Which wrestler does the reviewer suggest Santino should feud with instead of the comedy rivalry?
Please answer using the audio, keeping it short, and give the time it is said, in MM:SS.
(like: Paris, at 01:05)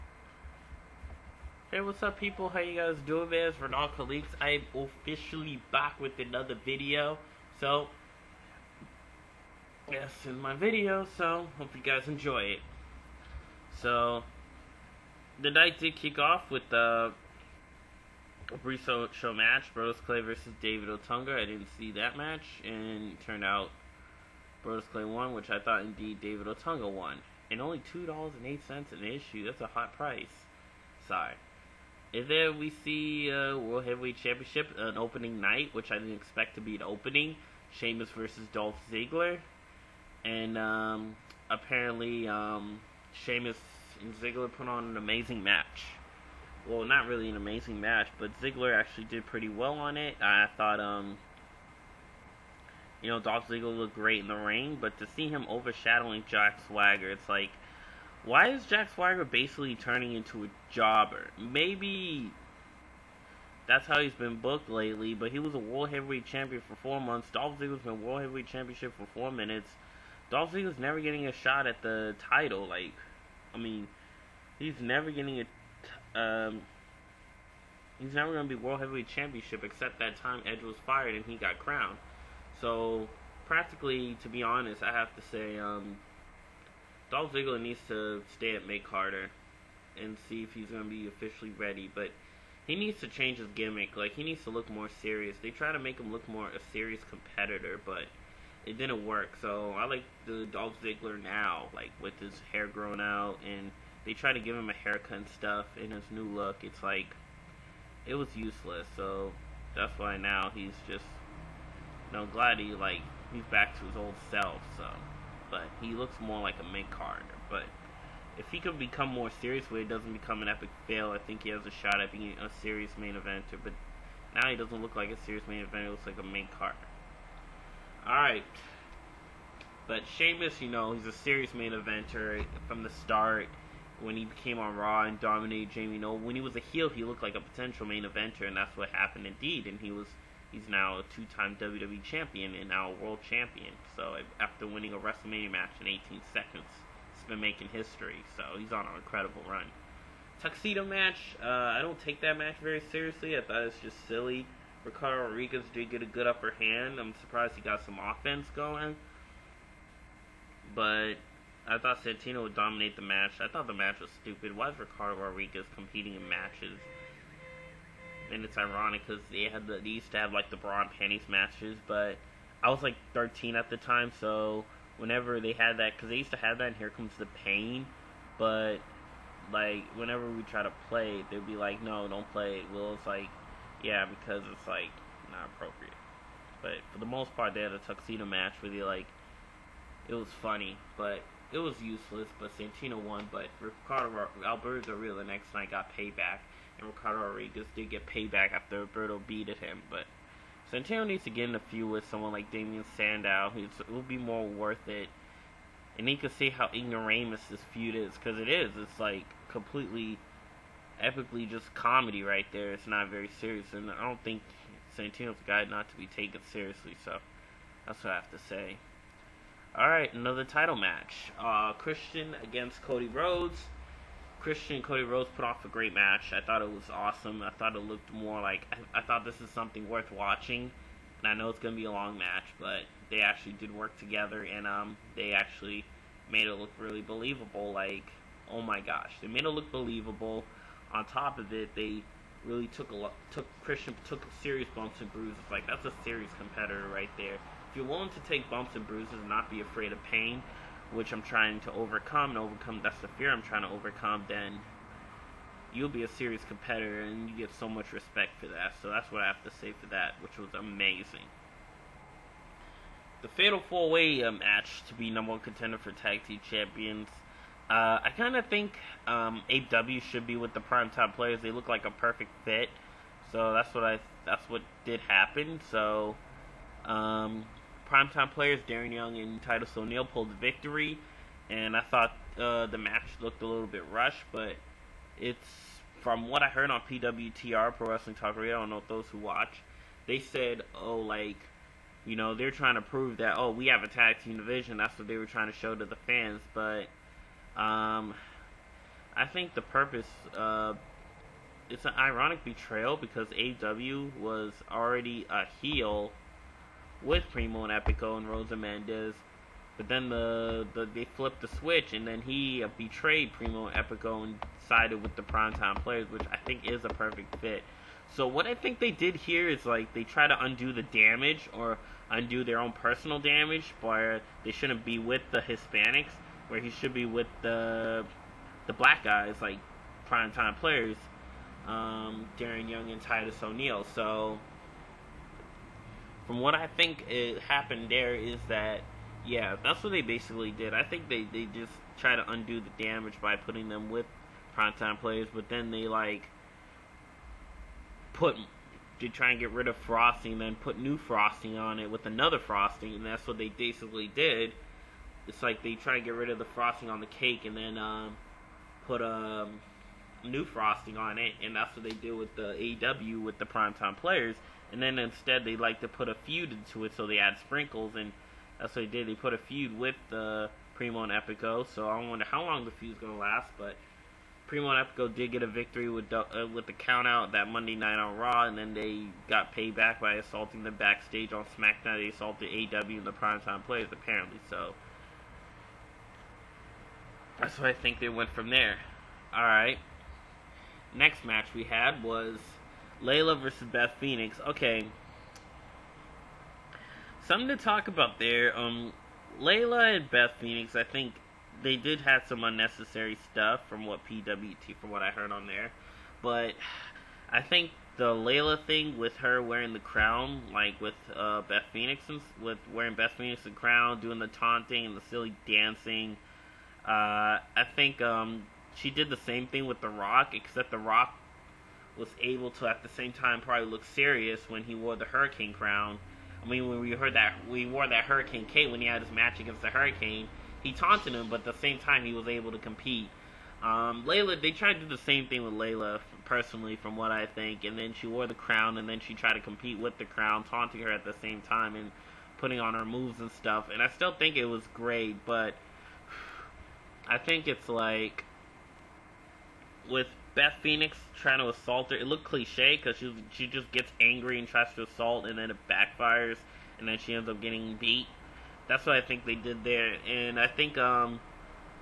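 Damien Sandow, at 03:22.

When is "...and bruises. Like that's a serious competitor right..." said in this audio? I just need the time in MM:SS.
04:04.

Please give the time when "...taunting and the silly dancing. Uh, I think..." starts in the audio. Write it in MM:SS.
06:54.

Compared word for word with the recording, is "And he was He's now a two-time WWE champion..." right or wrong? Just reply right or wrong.
right.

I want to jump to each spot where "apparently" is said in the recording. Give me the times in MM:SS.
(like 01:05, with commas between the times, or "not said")
00:41, 06:23.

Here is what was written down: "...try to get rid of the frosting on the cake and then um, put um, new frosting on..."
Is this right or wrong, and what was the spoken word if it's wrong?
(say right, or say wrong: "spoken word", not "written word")
right.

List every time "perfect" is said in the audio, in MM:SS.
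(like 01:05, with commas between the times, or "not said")
04:31, 05:16.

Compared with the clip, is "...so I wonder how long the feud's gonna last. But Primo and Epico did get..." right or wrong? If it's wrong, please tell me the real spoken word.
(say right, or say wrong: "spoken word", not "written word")
right.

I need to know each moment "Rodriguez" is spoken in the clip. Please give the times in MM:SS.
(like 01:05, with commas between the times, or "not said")
02:35, 02:45, 03:17.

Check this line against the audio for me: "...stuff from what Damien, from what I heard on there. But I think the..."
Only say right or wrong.
wrong.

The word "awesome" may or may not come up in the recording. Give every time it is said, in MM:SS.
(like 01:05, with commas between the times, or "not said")
03:46.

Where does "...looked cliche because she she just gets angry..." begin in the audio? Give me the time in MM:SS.
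07:32.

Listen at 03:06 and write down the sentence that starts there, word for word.
But for the most part, they had a tuxedo match where they like, it was funny, but it was useless.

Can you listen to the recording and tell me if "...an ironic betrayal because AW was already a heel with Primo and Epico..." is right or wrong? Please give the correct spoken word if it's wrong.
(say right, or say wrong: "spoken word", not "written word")
right.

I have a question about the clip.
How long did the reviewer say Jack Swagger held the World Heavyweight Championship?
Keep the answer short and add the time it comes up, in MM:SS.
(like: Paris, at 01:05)
4 months, at 01:06.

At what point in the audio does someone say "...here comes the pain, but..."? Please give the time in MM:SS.
02:56.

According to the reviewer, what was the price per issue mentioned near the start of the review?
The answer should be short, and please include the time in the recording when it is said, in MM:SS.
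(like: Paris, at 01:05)
$2.08, at 00:27.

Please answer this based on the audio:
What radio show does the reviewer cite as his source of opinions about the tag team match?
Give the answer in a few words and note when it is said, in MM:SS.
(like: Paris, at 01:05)
Pro Wrestling Talk Radio, at 04:47.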